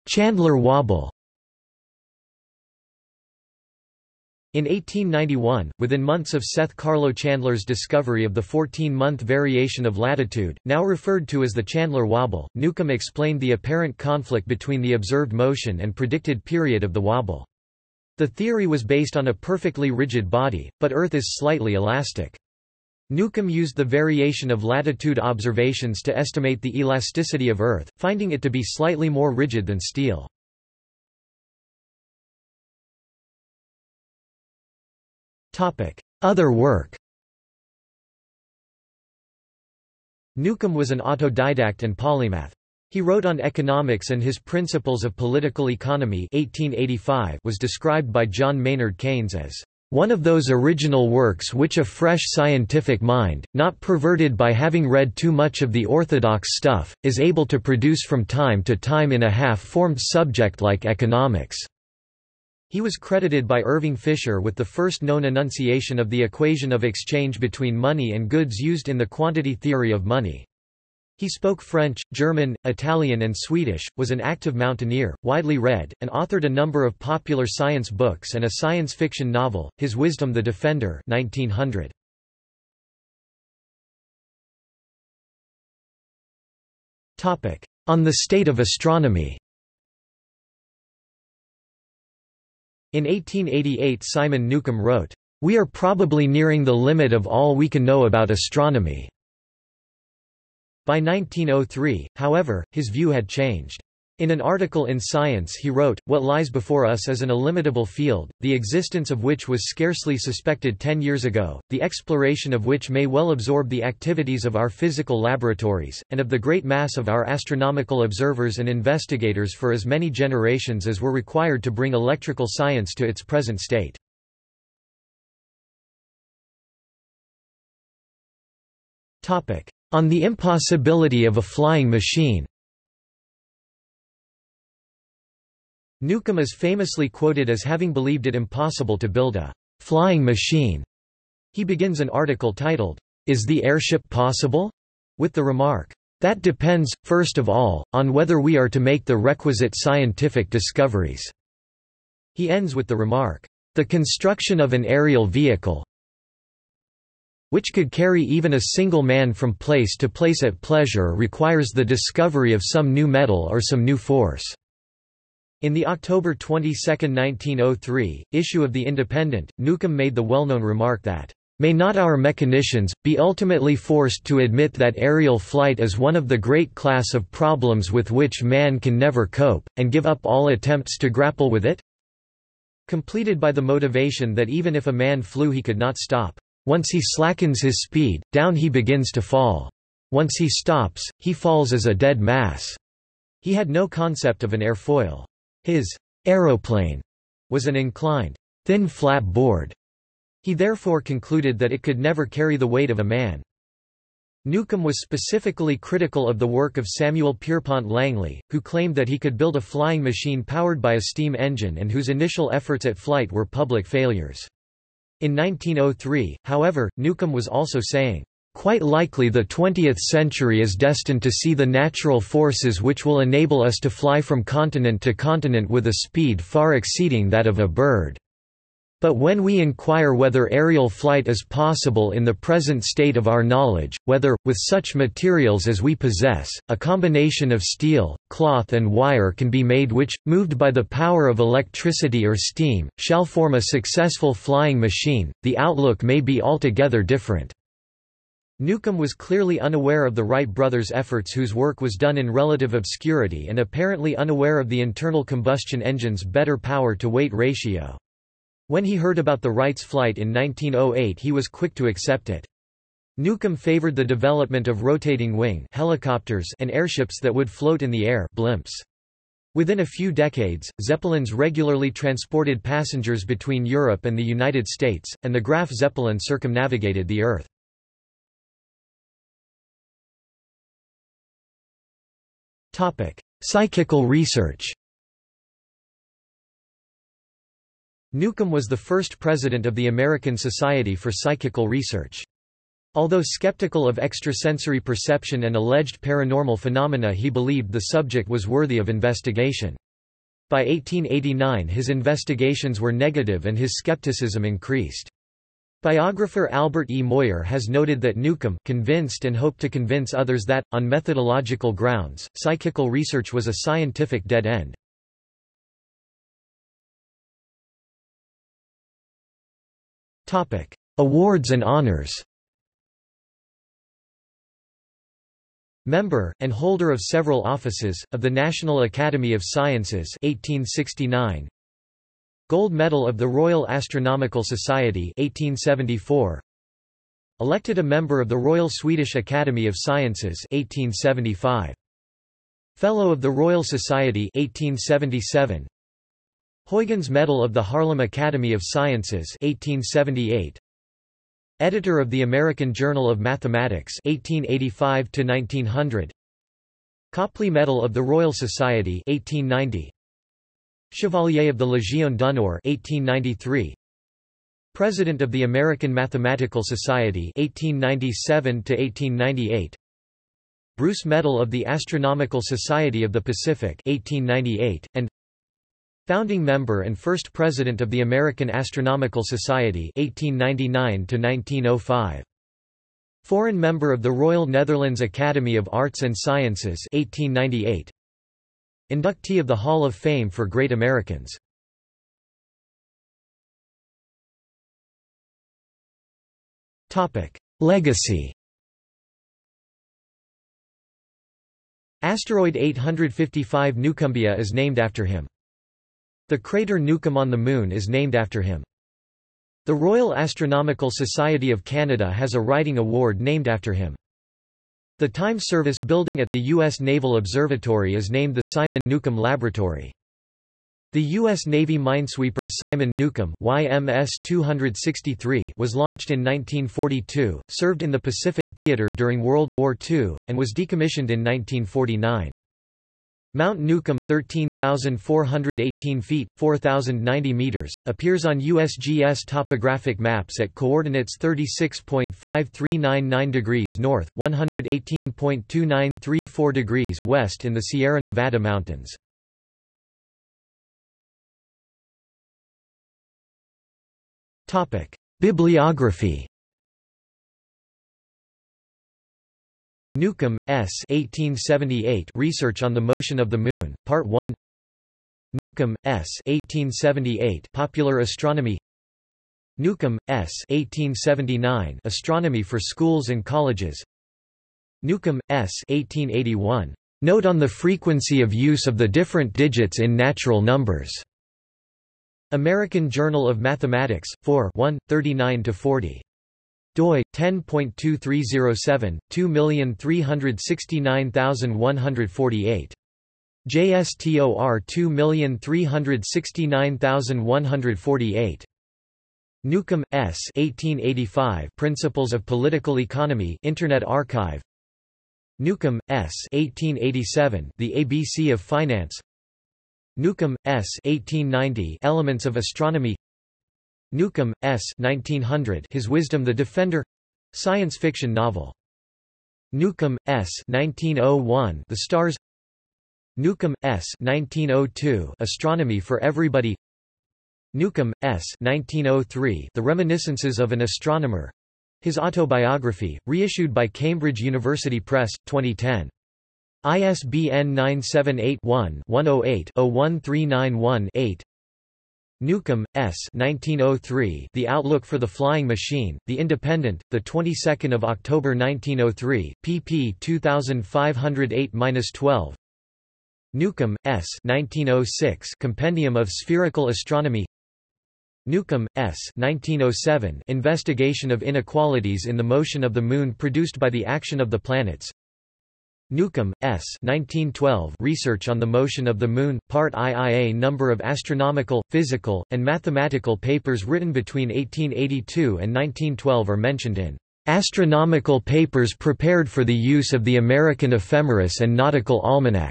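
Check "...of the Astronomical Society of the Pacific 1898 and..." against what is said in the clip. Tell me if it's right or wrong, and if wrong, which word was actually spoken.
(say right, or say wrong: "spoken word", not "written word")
right.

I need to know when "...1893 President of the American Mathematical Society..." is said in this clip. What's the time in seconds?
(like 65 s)
362 s.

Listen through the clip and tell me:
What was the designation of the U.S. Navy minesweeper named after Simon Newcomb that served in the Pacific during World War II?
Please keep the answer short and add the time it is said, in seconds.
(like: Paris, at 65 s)
YMS-263, at 423 s.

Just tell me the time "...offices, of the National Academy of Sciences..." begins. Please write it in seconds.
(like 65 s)
327 s.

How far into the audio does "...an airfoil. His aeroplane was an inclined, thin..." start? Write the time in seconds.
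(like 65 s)
194 s.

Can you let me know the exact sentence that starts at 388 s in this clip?
Inductee of the Hall of Fame for Great Americans.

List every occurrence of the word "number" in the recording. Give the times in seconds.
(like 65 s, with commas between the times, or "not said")
76 s, 480 s, 570 s.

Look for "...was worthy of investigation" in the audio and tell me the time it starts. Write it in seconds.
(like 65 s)
298 s.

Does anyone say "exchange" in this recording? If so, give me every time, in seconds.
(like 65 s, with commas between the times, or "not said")
66 s.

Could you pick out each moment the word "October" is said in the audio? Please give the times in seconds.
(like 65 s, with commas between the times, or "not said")
165 s, 547 s.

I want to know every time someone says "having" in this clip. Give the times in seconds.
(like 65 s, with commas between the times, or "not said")
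54 s, 137 s.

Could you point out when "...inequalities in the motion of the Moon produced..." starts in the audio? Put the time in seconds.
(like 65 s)
561 s.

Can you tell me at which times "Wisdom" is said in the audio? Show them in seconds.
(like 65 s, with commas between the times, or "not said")
79 s, 515 s.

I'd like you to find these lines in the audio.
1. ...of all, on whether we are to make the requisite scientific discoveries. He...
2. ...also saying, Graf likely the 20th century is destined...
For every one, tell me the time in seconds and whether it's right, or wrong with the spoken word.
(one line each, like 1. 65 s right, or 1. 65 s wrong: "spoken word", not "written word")
1. 147 s right
2. 217 s wrong: "Quite", not "Graf".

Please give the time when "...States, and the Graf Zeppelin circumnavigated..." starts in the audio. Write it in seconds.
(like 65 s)
274 s.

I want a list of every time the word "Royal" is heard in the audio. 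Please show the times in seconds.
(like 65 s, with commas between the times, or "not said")
333 s, 338 s, 343 s, 358 s, 384 s, 409 s.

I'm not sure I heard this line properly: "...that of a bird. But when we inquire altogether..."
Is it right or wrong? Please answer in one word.
wrong.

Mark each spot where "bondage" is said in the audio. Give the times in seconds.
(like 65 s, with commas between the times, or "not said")
not said.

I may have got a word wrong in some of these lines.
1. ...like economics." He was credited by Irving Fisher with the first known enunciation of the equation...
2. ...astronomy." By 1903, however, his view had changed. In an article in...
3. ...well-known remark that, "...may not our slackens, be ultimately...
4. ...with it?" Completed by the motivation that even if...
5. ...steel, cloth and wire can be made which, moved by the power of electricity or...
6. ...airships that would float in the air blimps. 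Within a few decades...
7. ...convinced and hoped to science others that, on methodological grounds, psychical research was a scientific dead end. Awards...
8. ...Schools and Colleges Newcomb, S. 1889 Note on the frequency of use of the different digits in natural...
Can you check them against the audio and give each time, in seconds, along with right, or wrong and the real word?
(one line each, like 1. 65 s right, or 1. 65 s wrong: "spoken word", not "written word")
1. 60 s right
2. 98 s right
3. 170 s wrong: "mechanicians", not "slackens"
4. 181 s right
5. 237 s right
6. 266 s right
7. 308 s wrong: "convince", not "science"
8. 472 s wrong: "1881", not "1889".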